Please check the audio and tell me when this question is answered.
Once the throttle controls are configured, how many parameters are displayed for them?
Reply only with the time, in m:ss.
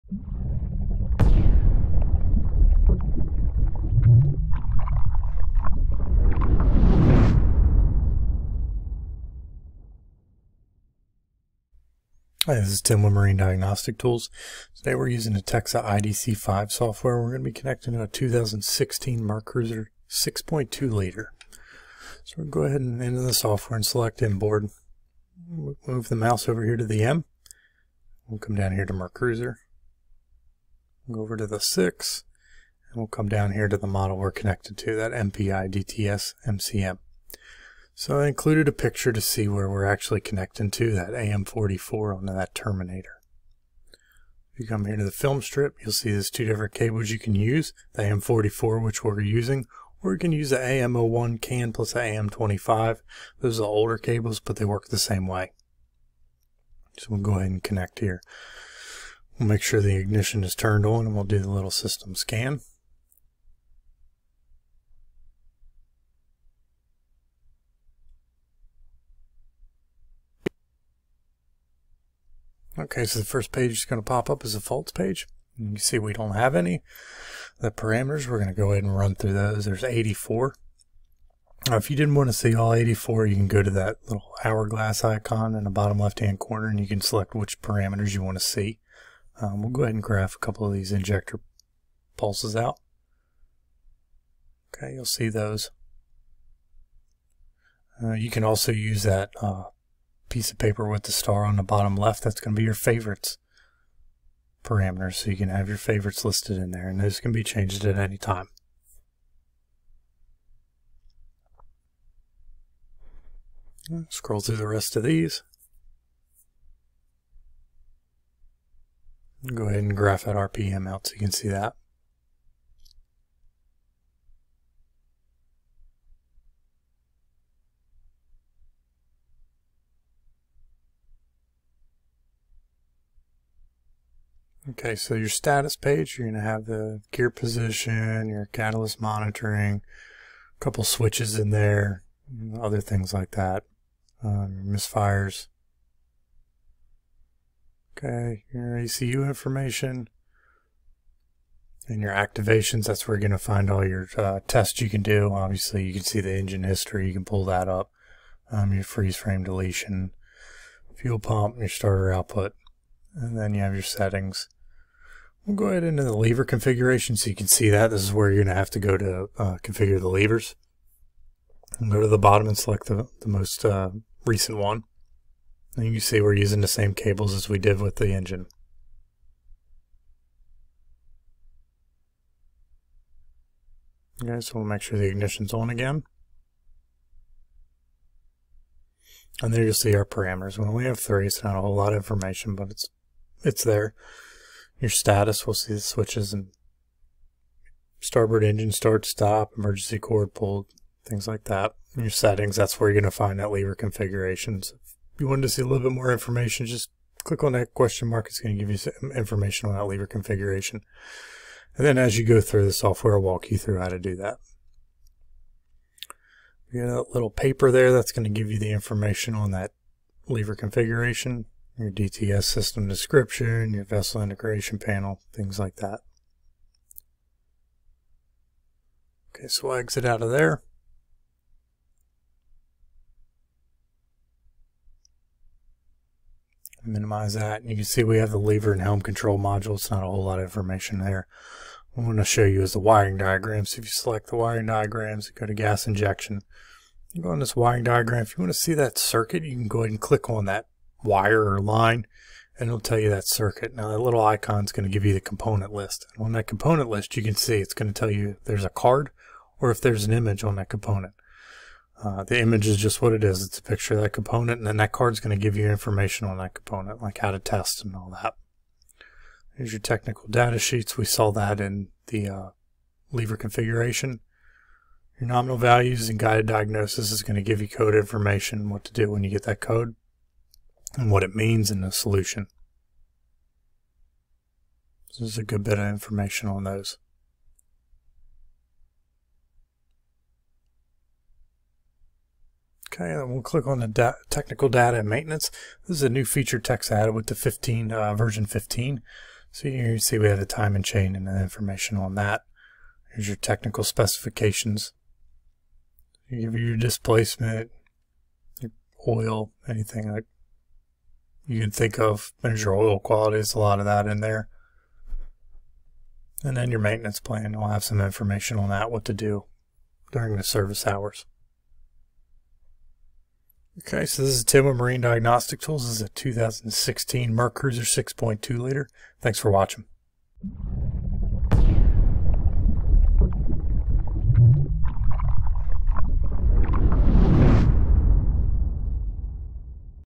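3:10.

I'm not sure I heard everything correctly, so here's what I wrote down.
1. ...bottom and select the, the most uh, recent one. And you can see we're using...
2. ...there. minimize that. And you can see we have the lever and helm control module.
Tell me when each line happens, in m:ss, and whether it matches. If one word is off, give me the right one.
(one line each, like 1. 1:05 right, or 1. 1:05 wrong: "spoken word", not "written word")
1. 2:52 right
2. 3:50 right.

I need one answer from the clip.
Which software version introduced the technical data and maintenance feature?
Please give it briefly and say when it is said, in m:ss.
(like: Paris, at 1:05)
Version 15, at 4:58.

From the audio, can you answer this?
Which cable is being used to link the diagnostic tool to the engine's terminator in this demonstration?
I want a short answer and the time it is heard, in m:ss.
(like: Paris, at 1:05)
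AM44, at 0:47.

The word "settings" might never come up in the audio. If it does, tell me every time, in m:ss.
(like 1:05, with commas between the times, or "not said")
2:43, 3:22.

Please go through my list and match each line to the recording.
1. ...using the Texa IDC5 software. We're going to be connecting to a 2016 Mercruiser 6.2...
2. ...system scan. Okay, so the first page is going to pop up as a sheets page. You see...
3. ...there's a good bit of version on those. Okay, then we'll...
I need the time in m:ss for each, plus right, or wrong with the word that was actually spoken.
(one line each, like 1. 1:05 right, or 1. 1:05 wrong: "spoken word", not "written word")
1. 0:15 right
2. 1:01 wrong: "faults", not "sheets"
3. 4:45 wrong: "information", not "version".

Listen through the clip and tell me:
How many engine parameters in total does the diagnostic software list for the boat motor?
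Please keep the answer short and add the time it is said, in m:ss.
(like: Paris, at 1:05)
84, at 1:19.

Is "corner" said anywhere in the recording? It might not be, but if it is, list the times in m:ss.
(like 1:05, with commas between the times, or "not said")
1:26.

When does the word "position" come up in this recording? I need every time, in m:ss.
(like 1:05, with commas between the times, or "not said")
2:17.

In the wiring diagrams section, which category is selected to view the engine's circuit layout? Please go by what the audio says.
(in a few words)
Gas injection.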